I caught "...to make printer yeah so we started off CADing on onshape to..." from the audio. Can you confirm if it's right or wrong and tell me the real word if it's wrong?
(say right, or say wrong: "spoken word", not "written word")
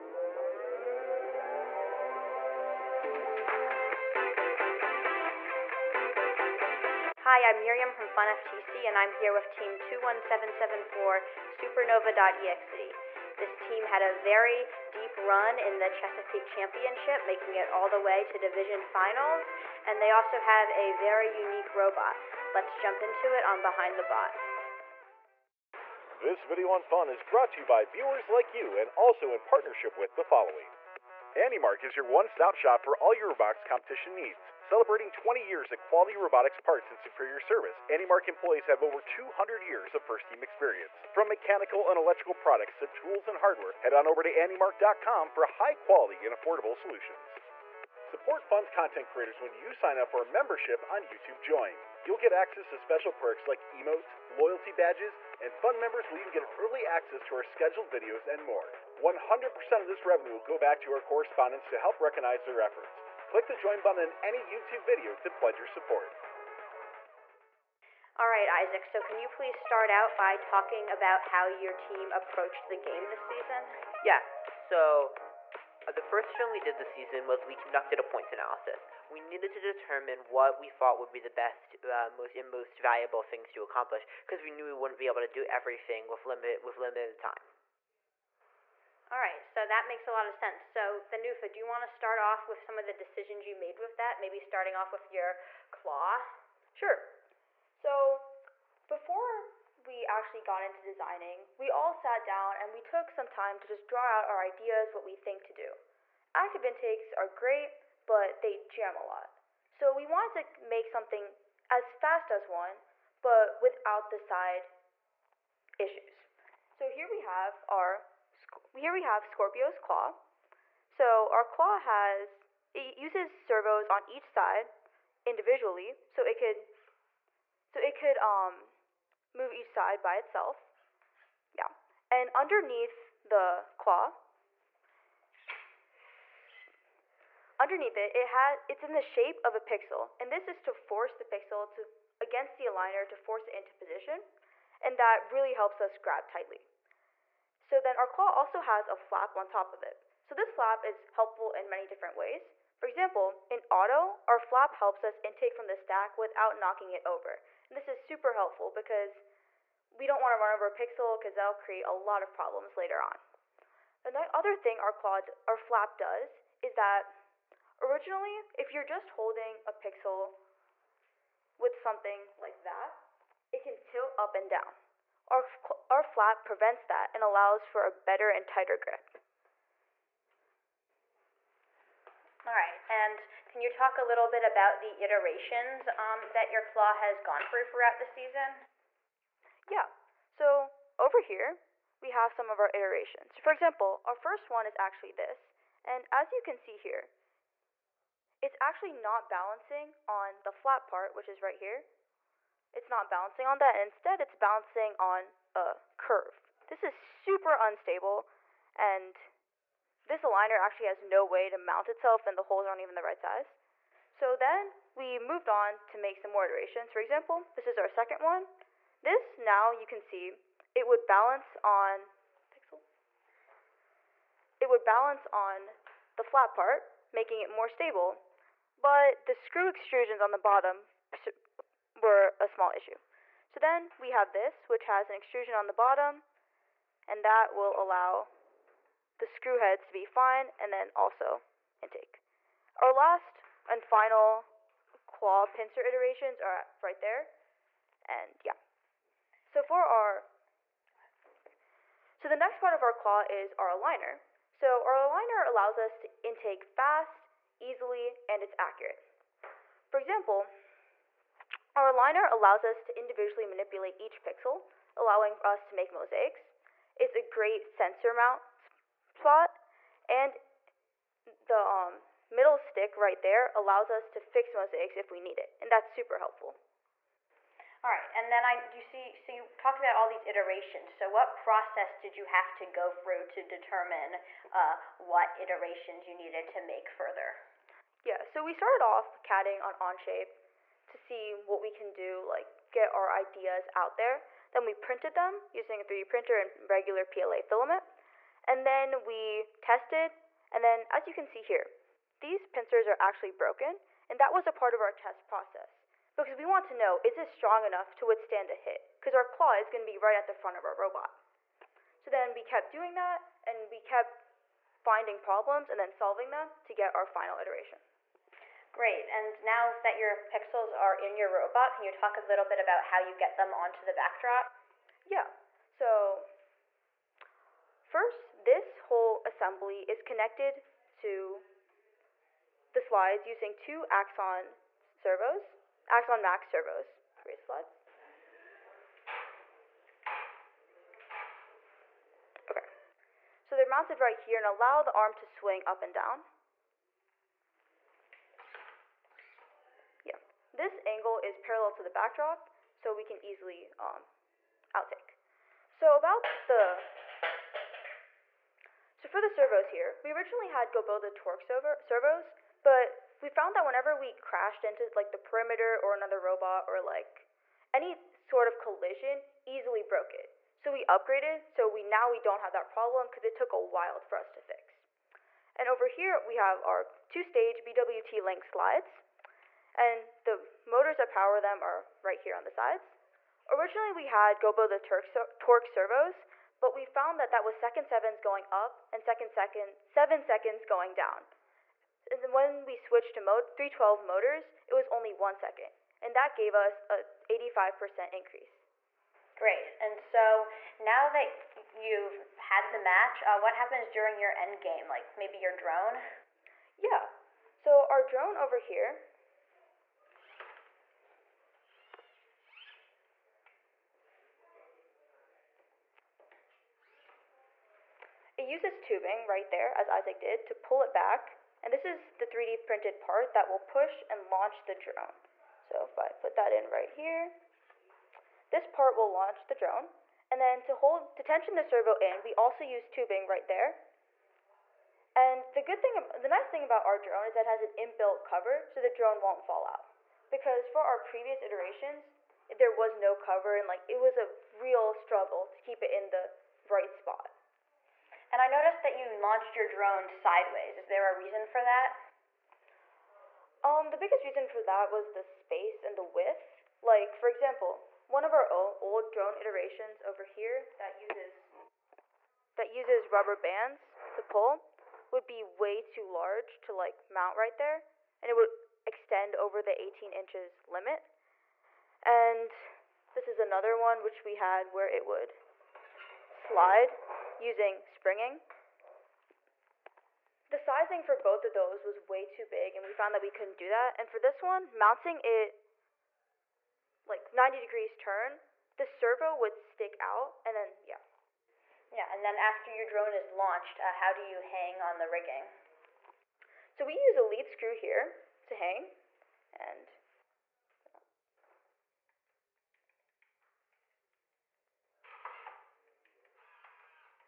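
wrong: "further", not "printer".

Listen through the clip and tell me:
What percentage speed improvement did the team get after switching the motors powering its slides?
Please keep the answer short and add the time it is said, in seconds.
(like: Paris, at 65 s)
85%, at 397 s.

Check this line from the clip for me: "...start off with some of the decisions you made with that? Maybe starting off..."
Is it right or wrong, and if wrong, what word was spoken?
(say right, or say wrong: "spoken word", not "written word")
right.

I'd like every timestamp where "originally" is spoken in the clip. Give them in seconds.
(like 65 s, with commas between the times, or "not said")
167 s, 360 s, 383 s.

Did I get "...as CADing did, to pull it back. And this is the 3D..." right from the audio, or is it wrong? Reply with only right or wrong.
wrong.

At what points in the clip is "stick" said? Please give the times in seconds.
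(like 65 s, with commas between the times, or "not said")
272 s, 489 s.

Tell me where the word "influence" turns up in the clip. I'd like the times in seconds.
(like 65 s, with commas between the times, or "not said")
not said.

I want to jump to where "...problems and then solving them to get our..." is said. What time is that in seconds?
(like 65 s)
315 s.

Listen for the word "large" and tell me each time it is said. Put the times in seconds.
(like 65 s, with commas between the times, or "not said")
466 s.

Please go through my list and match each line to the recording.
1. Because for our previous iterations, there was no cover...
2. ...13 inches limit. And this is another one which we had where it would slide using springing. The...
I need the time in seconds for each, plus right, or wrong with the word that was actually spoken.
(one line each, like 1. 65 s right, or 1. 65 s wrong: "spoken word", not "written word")
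1. 440 s right
2. 469 s wrong: "18", not "13".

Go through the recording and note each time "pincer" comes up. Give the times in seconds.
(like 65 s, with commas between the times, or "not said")
245 s, 302 s.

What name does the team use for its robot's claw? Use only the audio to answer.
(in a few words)
Scorpio.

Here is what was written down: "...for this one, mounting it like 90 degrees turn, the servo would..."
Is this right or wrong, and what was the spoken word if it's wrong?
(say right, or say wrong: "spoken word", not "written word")
right.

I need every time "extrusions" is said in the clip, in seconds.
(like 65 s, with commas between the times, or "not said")
229 s, 235 s.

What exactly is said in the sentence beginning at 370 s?
So we upgraded, so we now we don't have that problem because it took a while for us to fix.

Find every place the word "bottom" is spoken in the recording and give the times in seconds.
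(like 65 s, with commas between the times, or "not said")
230 s, 235 s.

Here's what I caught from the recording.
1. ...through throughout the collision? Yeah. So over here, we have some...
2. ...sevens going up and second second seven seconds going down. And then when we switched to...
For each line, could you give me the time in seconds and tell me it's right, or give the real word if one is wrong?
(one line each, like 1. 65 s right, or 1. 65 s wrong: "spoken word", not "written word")
1. 187 s wrong: "season", not "collision"
2. 387 s right.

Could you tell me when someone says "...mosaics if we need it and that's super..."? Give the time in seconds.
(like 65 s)
274 s.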